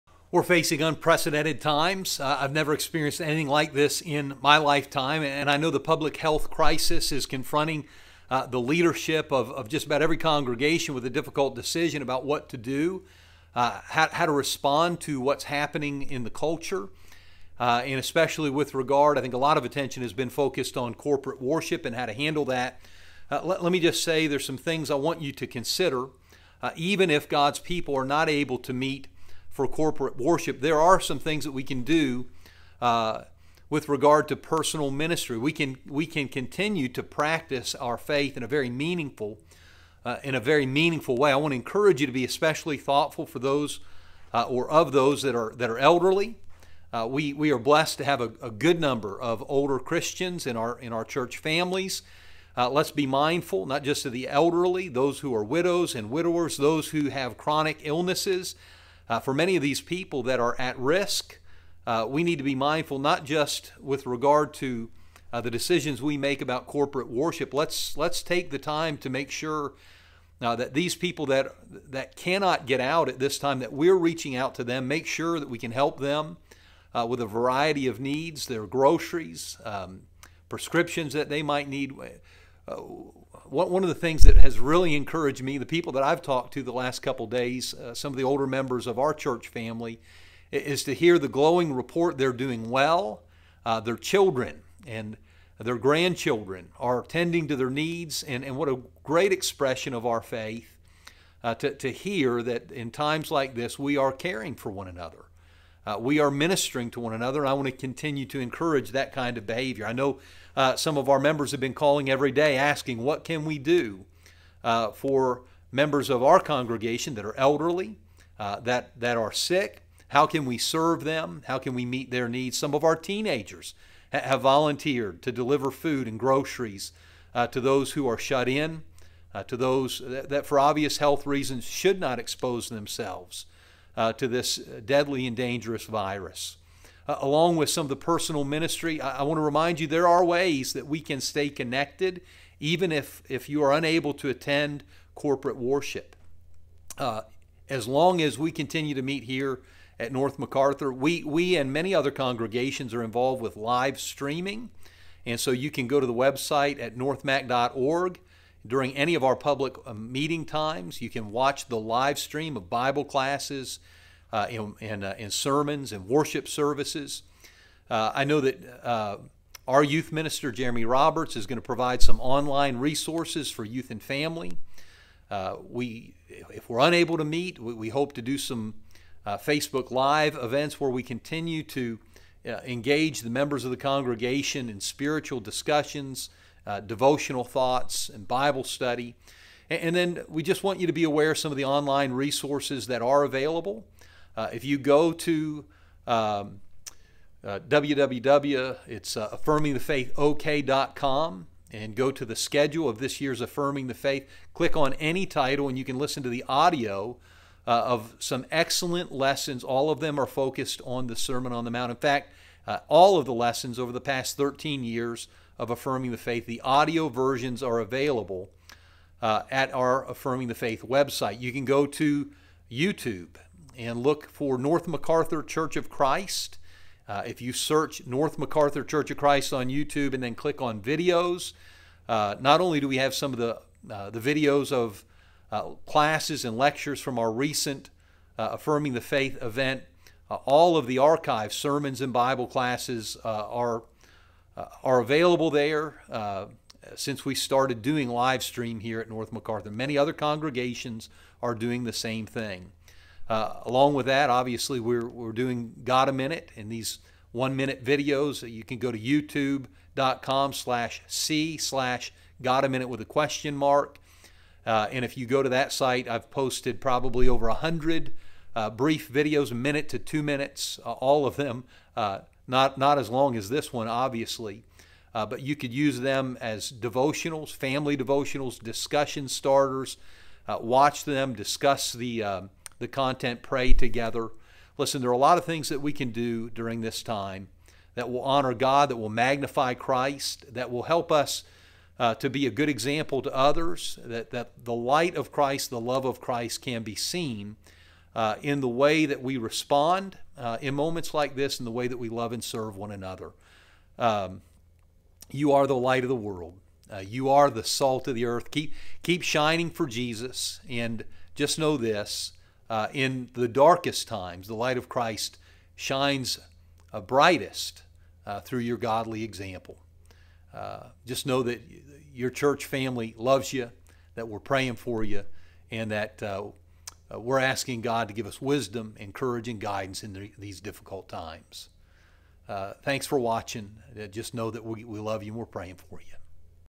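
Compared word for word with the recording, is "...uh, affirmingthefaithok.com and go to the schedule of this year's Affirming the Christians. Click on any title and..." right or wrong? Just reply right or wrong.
wrong.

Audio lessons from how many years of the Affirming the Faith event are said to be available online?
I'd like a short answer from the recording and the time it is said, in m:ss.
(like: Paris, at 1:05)
13, at 3:34.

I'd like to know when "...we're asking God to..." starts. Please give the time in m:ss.
5:27.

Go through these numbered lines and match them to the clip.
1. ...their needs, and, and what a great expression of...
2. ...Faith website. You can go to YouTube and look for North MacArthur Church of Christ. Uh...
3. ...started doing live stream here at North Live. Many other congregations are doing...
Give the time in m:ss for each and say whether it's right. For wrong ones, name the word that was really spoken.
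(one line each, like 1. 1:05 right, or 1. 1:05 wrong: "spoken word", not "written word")
1. 1:37 right
2. 3:40 right
3. 4:07 wrong: "MacArthur", not "Live".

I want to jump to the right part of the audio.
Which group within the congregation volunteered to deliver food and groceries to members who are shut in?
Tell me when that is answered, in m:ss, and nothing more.
2:02.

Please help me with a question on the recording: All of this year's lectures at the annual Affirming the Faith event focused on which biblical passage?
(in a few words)
Sermon on the Mount.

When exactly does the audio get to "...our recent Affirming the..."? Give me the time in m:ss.
3:57.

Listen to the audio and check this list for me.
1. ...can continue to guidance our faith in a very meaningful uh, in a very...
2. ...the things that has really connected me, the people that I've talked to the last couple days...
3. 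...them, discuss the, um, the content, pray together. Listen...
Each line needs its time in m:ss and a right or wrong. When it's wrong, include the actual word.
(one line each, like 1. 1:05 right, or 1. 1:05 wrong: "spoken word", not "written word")
1. 0:36 wrong: "practice", not "guidance"
2. 1:23 wrong: "encouraged", not "connected"
3. 4:41 right.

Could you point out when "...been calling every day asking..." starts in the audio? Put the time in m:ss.
1:51.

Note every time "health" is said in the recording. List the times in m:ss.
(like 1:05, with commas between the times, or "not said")
0:06, 2:10.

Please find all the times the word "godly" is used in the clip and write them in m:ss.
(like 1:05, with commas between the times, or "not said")
5:18.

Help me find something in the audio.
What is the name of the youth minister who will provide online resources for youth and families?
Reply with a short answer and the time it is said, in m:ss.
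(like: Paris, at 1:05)
Jeremy Roberts, at 2:50.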